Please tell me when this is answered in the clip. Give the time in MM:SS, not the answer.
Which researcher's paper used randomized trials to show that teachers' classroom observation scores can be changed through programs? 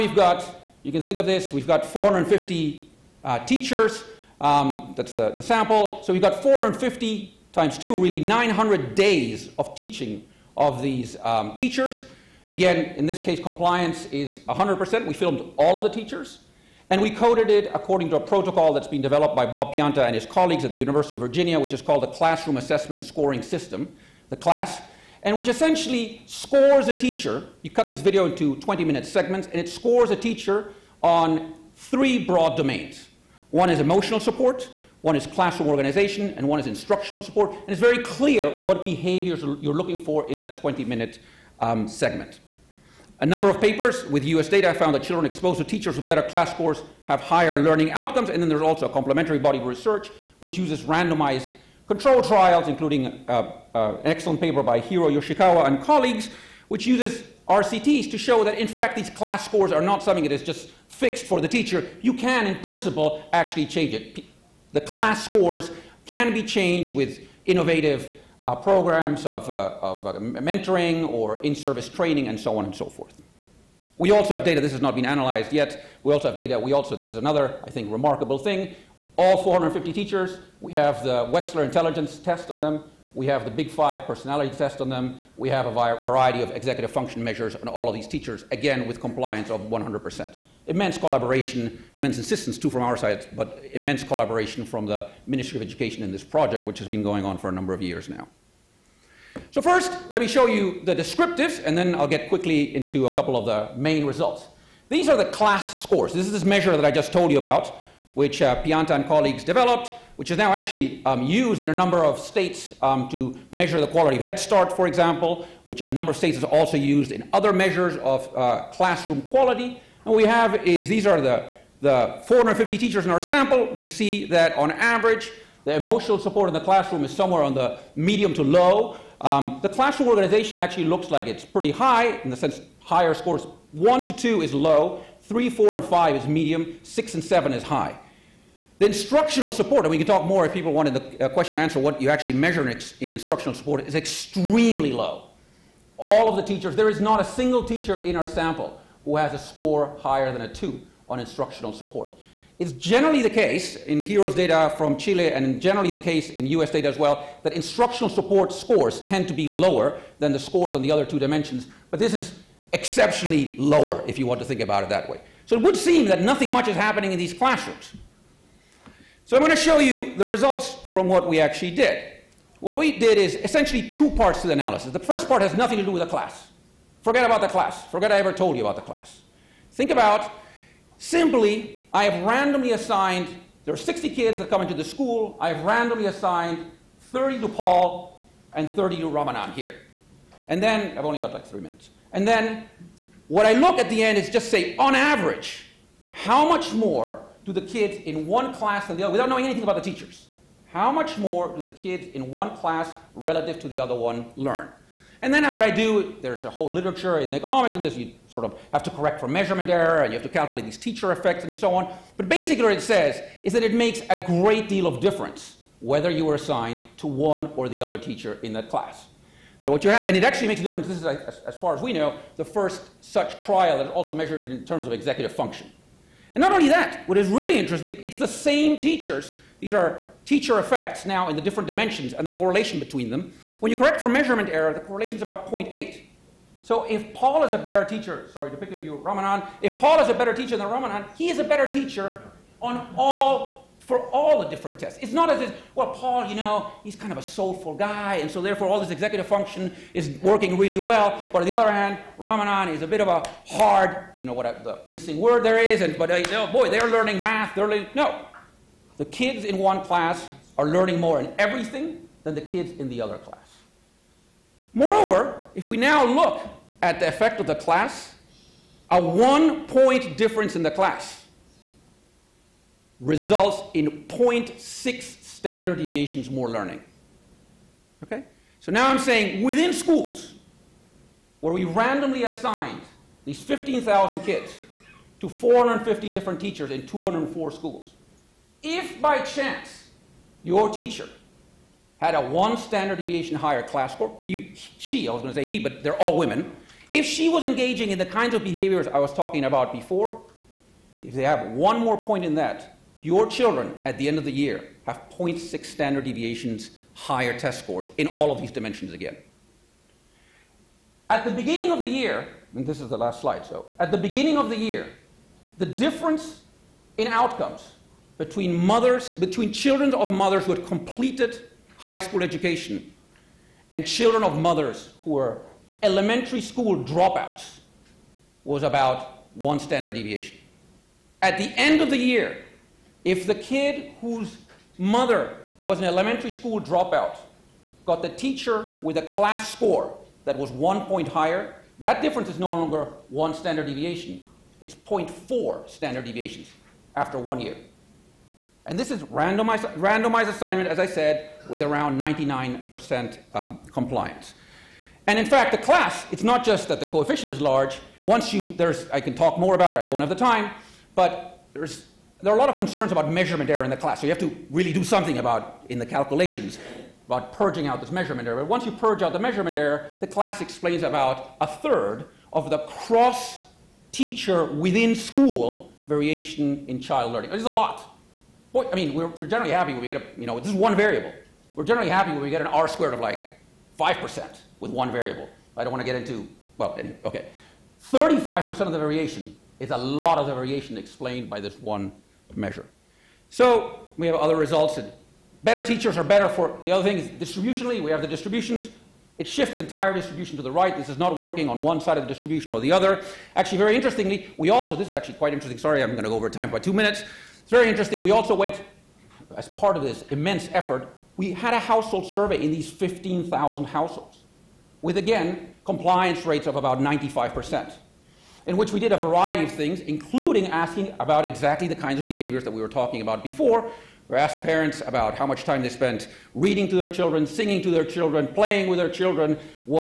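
00:54.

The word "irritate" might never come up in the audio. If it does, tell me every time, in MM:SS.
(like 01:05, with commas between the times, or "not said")
not said.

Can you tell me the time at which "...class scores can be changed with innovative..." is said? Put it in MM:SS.
01:04.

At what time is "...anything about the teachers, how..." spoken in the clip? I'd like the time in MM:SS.
03:19.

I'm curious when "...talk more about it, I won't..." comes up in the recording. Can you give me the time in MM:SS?
05:59.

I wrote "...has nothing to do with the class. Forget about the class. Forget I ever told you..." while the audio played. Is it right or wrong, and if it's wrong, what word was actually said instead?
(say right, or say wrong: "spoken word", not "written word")
right.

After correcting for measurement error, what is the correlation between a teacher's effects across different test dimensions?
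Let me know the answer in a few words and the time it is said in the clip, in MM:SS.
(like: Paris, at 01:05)
0.8, at 03:55.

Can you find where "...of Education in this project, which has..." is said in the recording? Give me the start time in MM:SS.
01:35.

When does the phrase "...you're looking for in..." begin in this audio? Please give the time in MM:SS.
00:39.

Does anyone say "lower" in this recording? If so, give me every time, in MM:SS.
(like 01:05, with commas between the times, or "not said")
02:39, 02:43.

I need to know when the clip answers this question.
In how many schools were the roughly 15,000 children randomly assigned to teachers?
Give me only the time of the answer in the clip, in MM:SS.
04:46.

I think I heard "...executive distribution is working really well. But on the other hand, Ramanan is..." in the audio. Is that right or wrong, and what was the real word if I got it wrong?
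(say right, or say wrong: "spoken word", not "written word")
wrong: "function", not "distribution".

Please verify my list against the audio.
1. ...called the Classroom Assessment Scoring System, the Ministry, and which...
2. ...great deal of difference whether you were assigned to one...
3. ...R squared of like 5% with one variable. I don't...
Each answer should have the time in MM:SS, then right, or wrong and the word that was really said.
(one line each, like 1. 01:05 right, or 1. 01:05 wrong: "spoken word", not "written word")
1. 00:21 wrong: "CLASS", not "Ministry"
2. 03:34 right
3. 06:22 right.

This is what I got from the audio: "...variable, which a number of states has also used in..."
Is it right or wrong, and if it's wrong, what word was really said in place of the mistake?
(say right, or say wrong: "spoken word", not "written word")
wrong: "example", not "variable".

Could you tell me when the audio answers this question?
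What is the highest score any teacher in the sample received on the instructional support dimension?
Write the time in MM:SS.
02:30.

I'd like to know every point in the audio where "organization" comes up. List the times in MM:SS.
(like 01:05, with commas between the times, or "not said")
00:35, 02:10.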